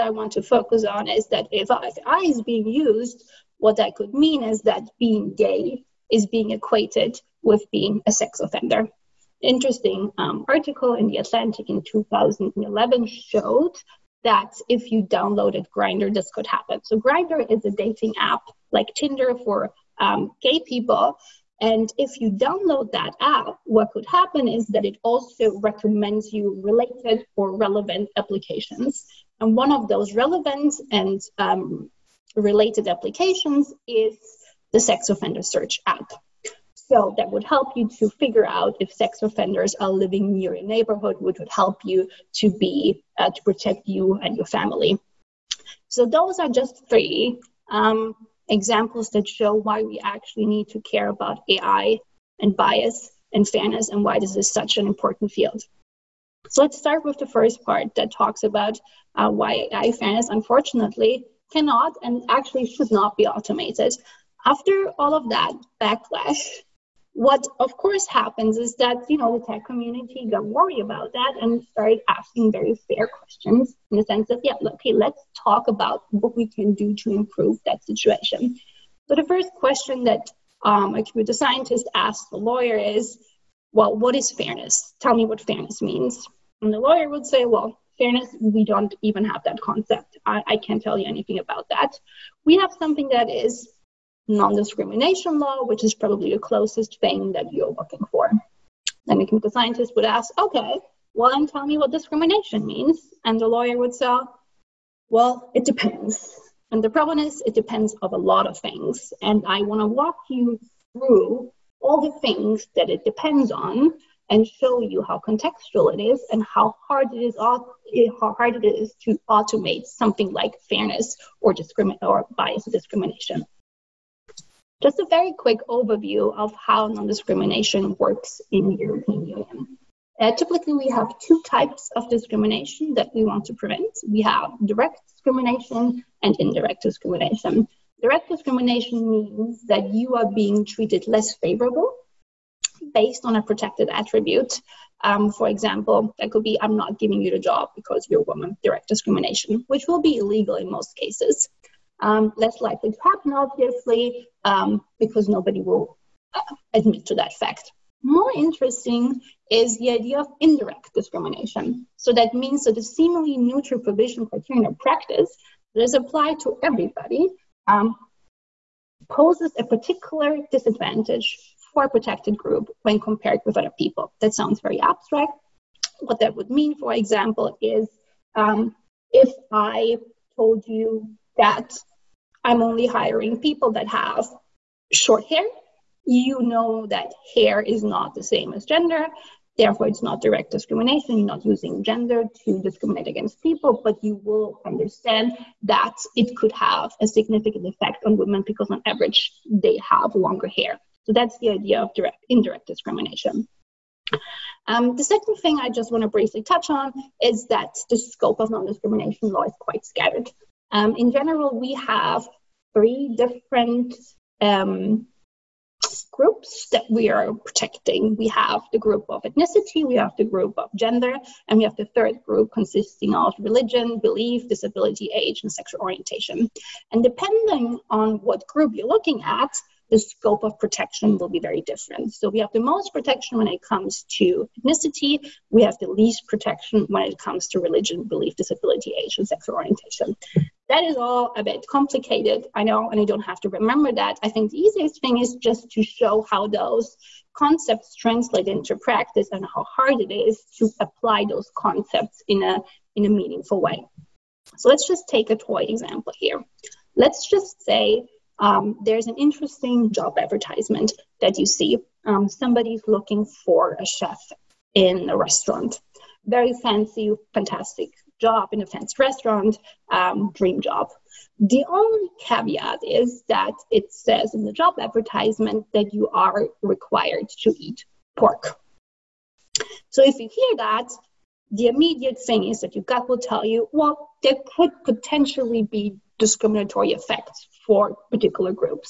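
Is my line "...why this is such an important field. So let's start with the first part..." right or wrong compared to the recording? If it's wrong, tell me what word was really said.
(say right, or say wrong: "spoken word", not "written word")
right.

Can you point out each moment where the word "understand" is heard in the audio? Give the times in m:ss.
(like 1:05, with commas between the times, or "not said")
3:14.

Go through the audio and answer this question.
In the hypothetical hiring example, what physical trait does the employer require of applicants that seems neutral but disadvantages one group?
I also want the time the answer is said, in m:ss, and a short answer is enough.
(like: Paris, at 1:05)
Short hair, at 3:04.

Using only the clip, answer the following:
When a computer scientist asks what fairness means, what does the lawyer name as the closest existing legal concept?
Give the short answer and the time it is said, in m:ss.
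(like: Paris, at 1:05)
Non-discrimination law, at 1:34.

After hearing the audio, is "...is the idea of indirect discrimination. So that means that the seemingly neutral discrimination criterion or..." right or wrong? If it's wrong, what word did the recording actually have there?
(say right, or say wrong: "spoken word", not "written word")
wrong: "provision", not "discrimination".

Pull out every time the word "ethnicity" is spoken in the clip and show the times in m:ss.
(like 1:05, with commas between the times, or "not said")
3:39, 3:54.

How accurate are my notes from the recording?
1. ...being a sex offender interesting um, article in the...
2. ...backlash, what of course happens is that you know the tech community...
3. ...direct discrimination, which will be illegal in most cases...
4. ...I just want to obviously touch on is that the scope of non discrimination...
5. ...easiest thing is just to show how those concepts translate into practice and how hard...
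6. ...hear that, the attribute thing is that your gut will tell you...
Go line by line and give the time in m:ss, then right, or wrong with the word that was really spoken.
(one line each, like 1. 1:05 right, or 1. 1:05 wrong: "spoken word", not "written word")
1. 0:07 right
2. 1:05 right
3. 2:28 right
4. 3:25 wrong: "briefly", not "obviously"
5. 4:04 right
6. 4:40 wrong: "immediate", not "attribute".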